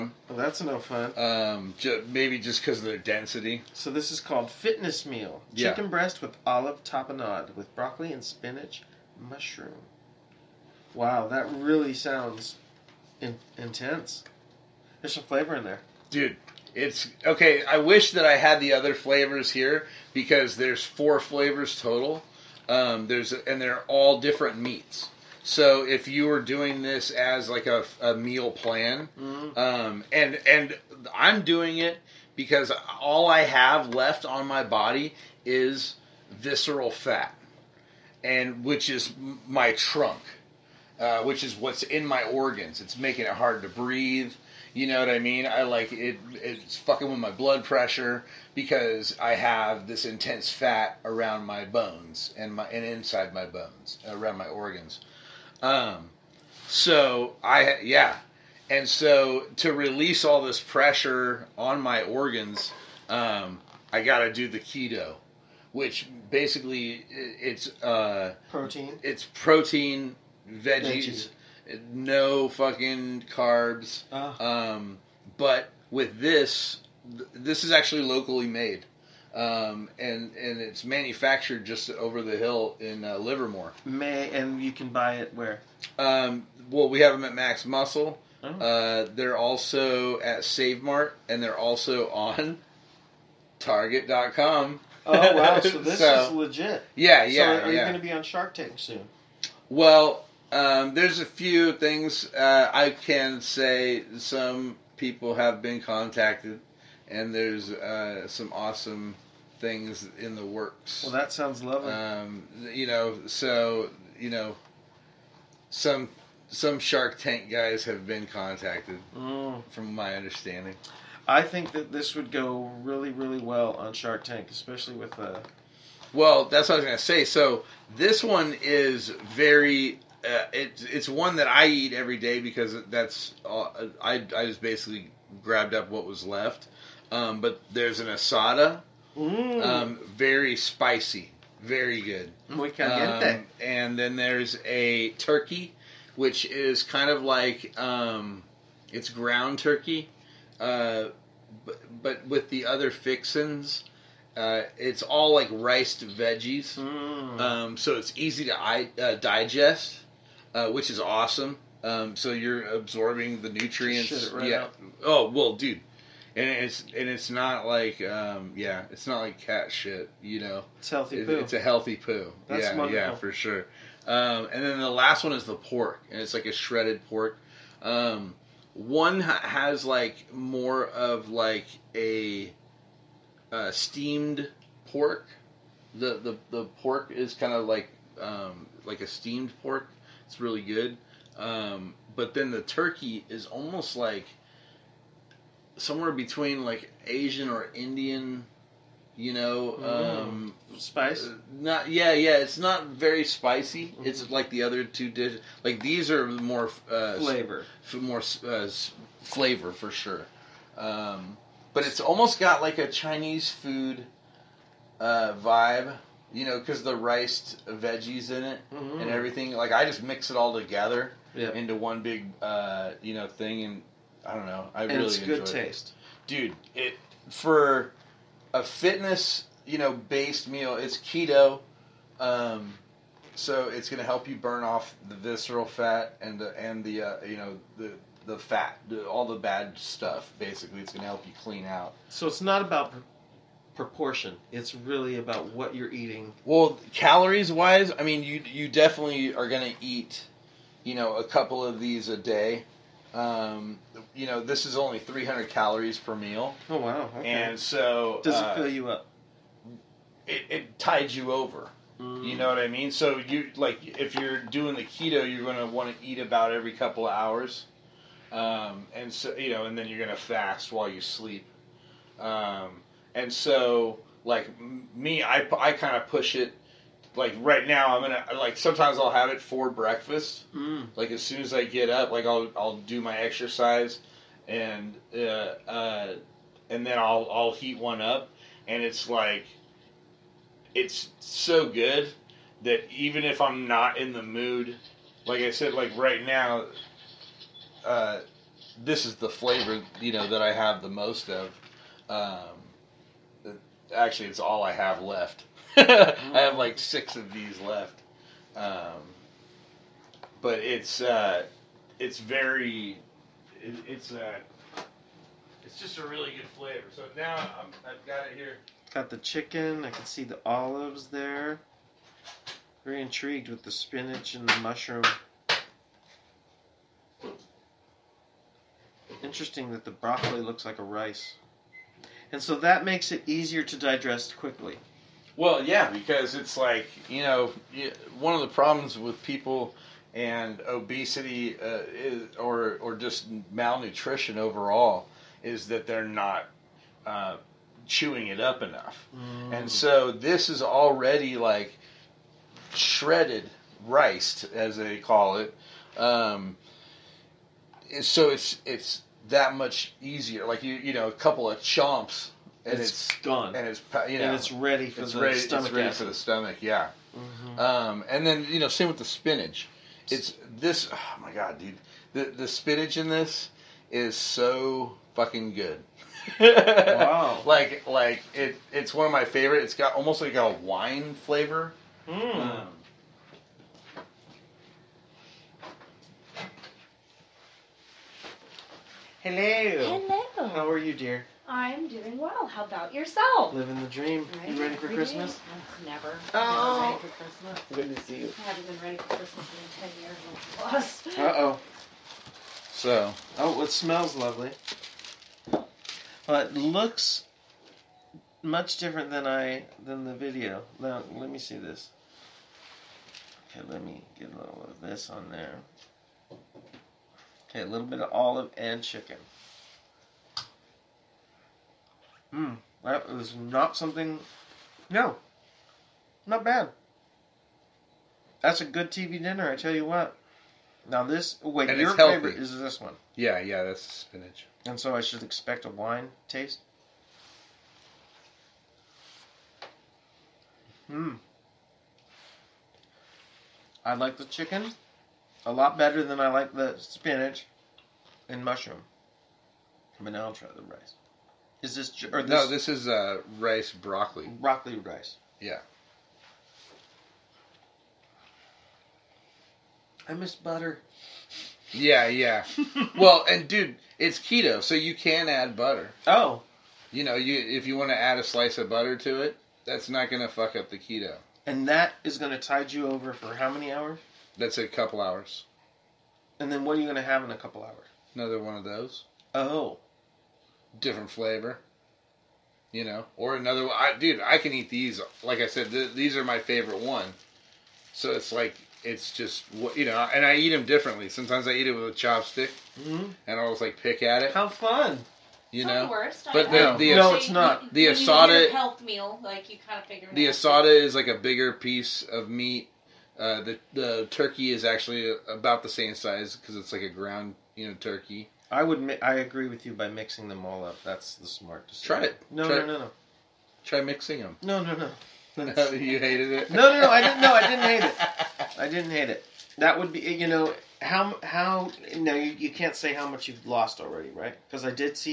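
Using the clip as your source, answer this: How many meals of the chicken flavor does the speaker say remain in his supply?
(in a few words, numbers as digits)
6.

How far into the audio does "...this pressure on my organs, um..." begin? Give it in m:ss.
1:00.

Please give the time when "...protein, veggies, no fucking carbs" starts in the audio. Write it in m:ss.
1:09.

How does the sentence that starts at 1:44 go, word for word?
Some people have been contacted, and there's uh, some awesome things in the works.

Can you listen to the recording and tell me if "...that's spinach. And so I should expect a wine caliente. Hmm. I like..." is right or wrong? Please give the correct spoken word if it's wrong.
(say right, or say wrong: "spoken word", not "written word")
wrong: "taste", not "caliente".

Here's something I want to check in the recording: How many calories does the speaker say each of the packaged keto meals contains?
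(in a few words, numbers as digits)
300.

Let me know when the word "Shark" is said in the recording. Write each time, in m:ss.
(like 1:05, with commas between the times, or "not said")
1:38, 1:56, 2:03.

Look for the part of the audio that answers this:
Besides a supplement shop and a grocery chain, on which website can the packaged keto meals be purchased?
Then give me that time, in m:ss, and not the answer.
1:33.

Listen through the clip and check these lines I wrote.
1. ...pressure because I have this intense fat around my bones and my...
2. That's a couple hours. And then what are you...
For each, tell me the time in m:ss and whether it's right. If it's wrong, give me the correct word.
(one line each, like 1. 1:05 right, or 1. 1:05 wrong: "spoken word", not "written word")
1. 0:47 right
2. 7:54 right.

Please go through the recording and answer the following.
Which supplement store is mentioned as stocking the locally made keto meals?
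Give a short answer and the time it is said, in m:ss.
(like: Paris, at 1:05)
Max Muscle, at 1:27.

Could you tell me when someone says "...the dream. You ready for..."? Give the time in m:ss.
6:33.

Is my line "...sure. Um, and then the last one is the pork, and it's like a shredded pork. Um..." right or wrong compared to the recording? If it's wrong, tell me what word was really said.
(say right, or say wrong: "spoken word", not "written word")
right.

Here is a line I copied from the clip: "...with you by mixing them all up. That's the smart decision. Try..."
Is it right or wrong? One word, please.
right.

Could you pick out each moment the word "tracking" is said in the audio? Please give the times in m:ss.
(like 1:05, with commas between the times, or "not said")
not said.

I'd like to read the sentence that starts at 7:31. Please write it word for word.
Is this or this, No, this is uh, rice broccoli.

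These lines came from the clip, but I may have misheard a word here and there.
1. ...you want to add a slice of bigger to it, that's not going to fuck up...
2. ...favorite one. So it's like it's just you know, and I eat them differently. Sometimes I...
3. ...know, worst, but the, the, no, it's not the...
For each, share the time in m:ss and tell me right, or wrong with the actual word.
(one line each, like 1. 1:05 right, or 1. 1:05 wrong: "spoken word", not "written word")
1. 7:47 wrong: "butter", not "bigger"
2. 8:06 right
3. 8:15 right.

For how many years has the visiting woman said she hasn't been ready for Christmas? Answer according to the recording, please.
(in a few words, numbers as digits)
10 plus.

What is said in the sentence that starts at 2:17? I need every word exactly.
Um, but there's an asada Mm.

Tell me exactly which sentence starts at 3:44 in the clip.
I and really it's good taste, it.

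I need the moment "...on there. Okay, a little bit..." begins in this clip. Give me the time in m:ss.
6:55.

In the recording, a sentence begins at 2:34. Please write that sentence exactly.
Uh, it's all like riced veggies, mm.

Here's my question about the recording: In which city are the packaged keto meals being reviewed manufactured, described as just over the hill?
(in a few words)
Livermore.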